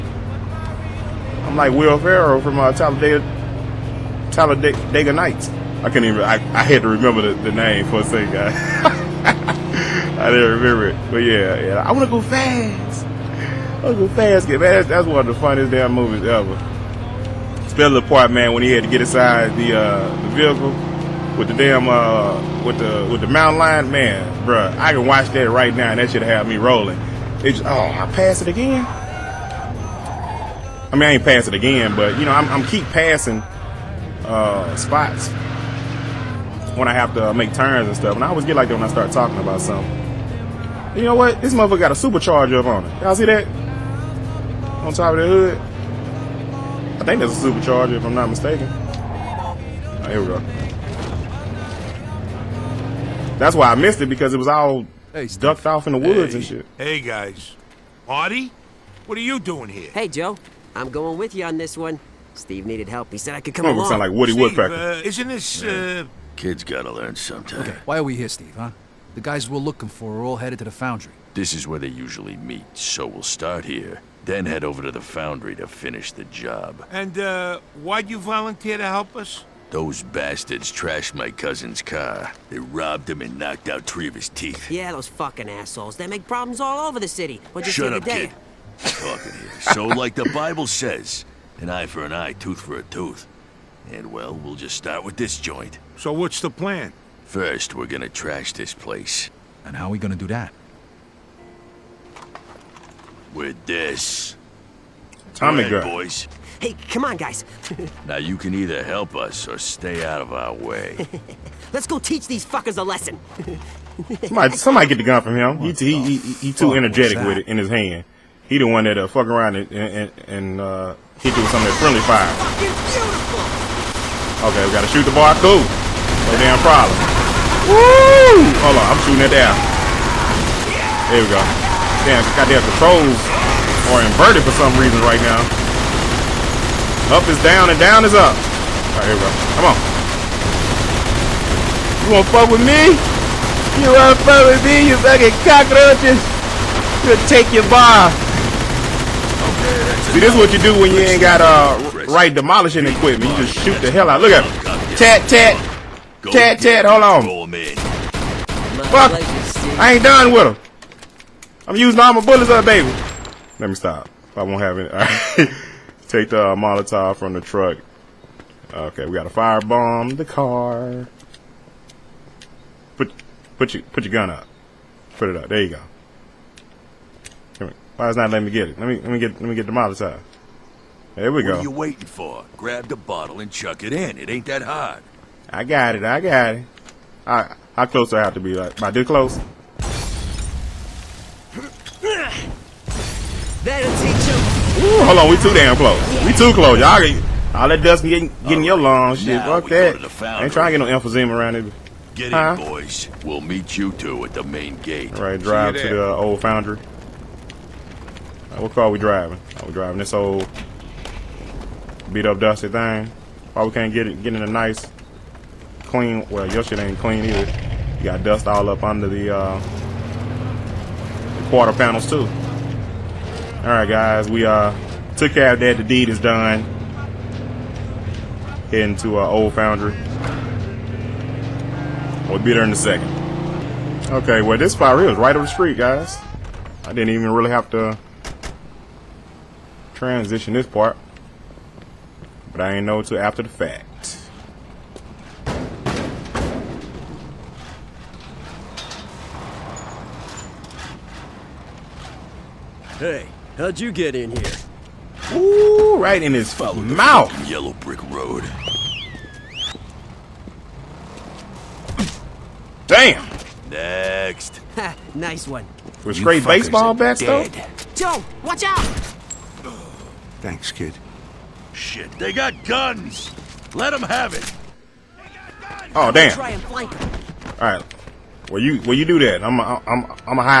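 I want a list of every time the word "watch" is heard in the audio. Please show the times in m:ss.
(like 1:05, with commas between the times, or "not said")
0:25, 4:28.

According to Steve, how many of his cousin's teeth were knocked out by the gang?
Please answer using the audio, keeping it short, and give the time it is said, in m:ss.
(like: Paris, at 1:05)
3, at 1:23.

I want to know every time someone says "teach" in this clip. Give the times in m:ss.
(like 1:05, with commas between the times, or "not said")
1:51, 3:13.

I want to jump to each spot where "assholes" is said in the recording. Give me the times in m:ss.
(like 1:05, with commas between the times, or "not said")
1:25.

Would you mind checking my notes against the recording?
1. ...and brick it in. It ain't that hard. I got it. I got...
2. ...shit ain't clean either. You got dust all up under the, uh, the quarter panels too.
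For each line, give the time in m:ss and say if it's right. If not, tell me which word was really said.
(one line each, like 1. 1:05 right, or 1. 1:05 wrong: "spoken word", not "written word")
1. 3:03 wrong: "chuck", not "brick"
2. 3:36 right.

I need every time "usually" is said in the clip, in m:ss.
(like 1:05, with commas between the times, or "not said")
1:11.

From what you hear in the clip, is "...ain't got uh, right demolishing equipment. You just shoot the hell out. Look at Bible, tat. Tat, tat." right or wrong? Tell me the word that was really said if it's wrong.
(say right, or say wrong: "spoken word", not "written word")
wrong: "Tat", not "Bible".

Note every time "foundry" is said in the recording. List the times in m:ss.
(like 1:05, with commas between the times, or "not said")
1:10, 1:15, 3:26, 3:49.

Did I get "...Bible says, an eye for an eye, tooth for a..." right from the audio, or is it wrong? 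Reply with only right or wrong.
right.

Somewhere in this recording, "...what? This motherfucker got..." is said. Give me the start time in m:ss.
0:41.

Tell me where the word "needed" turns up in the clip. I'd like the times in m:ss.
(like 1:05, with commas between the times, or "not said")
1:02.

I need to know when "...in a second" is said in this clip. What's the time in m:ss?
3:52.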